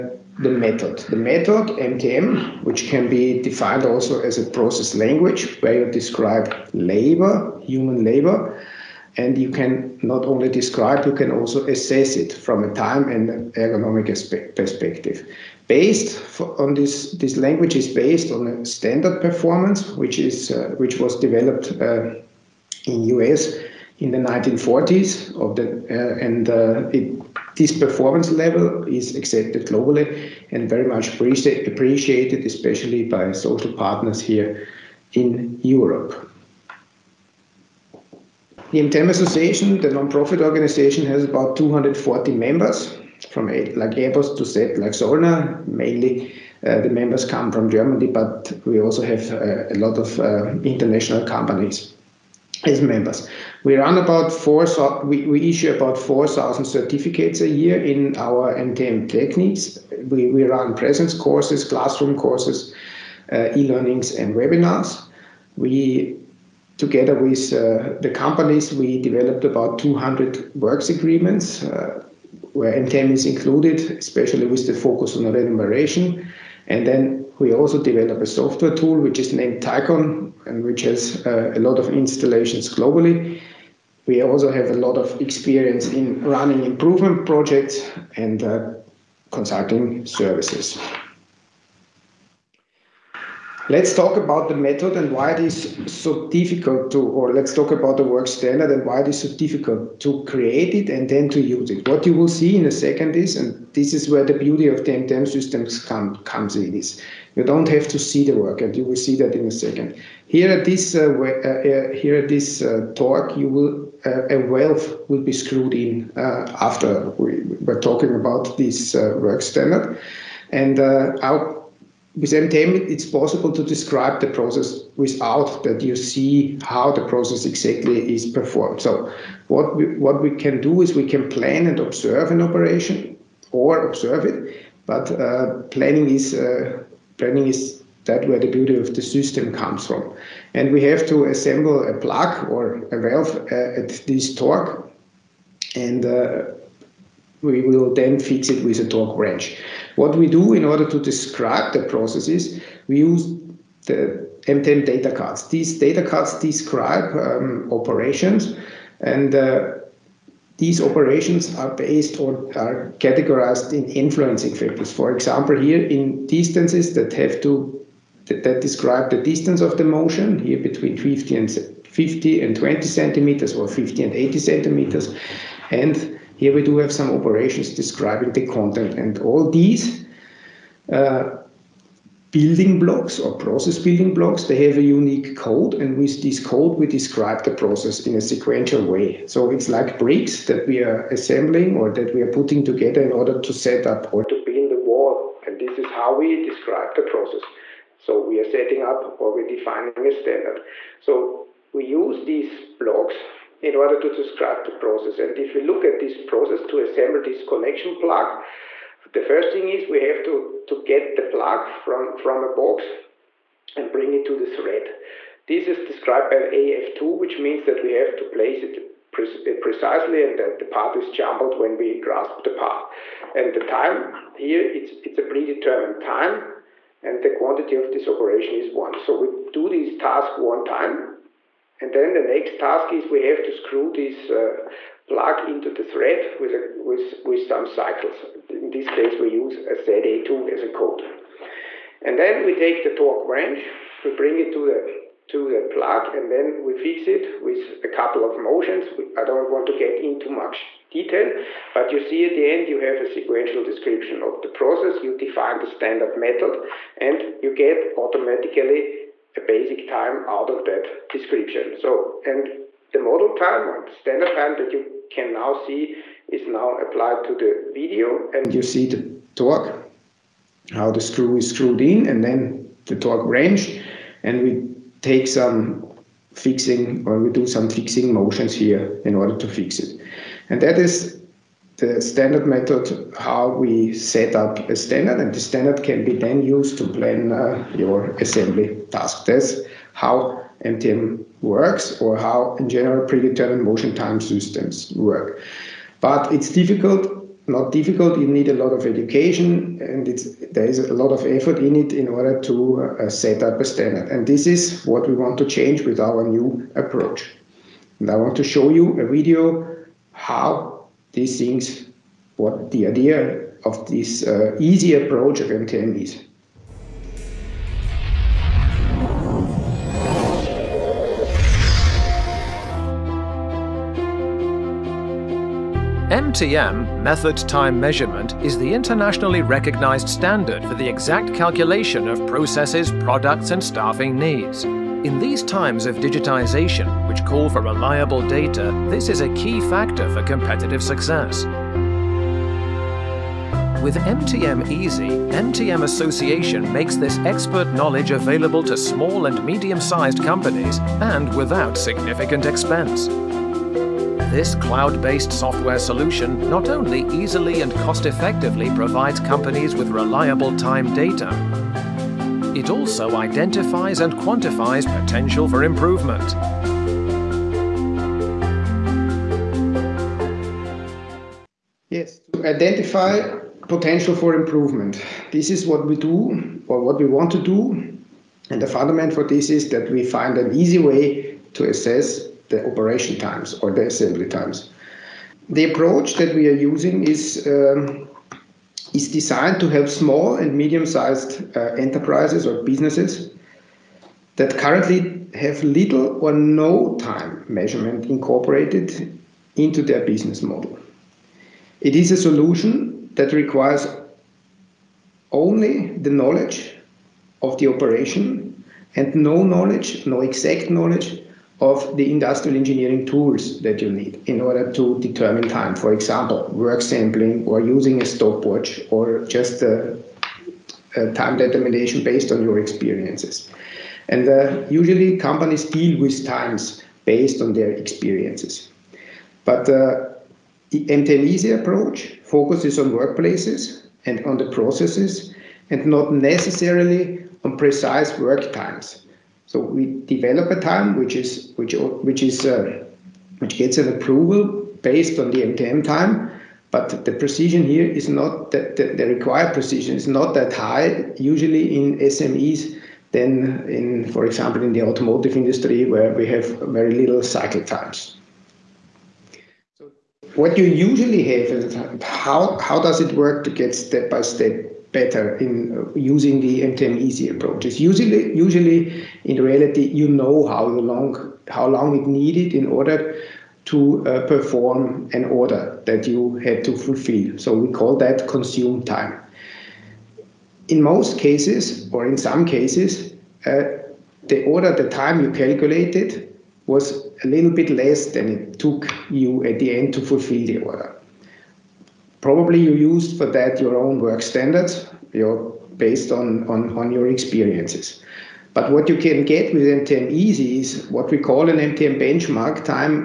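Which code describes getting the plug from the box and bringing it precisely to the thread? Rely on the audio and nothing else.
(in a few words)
AF2.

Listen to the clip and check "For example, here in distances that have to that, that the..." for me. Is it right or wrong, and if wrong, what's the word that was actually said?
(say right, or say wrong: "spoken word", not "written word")
right.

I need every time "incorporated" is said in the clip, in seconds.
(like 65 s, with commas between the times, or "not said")
398 s.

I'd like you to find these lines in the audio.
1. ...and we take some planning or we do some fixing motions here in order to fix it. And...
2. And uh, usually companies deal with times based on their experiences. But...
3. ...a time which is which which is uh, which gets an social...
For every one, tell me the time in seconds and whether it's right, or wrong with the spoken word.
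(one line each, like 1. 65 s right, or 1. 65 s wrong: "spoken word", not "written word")
1. 274 s wrong: "fixing", not "planning"
2. 424 s right
3. 440 s wrong: "approval", not "social".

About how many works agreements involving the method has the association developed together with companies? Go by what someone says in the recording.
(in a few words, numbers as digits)
200.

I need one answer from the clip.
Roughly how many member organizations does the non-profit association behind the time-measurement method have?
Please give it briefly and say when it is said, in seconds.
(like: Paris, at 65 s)
240, at 41 s.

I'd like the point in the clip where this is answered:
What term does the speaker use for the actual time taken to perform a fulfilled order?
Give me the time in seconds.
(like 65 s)
478 s.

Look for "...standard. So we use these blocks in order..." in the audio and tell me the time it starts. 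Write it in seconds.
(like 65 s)
200 s.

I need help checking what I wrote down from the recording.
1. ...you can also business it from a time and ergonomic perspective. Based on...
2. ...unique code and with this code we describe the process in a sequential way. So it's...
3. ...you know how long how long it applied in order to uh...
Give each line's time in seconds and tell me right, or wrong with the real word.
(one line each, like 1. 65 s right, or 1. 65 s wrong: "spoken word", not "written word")
1. 11 s wrong: "assess", not "business"
2. 184 s right
3. 469 s wrong: "needed", not "applied".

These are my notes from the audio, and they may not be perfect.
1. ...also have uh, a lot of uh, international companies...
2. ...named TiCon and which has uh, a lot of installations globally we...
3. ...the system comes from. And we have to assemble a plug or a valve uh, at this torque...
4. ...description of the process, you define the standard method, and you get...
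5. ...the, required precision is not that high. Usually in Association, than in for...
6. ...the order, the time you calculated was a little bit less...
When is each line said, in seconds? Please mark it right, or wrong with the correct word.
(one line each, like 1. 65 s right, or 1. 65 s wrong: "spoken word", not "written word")
1. 48 s right
2. 79 s right
3. 138 s right
4. 253 s right
5. 448 s wrong: "SMEs", not "Association"
6. 484 s right.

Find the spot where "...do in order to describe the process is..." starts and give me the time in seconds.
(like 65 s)
150 s.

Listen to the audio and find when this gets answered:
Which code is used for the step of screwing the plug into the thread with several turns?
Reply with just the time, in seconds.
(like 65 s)
239 s.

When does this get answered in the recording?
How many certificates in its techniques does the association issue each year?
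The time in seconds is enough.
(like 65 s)
55 s.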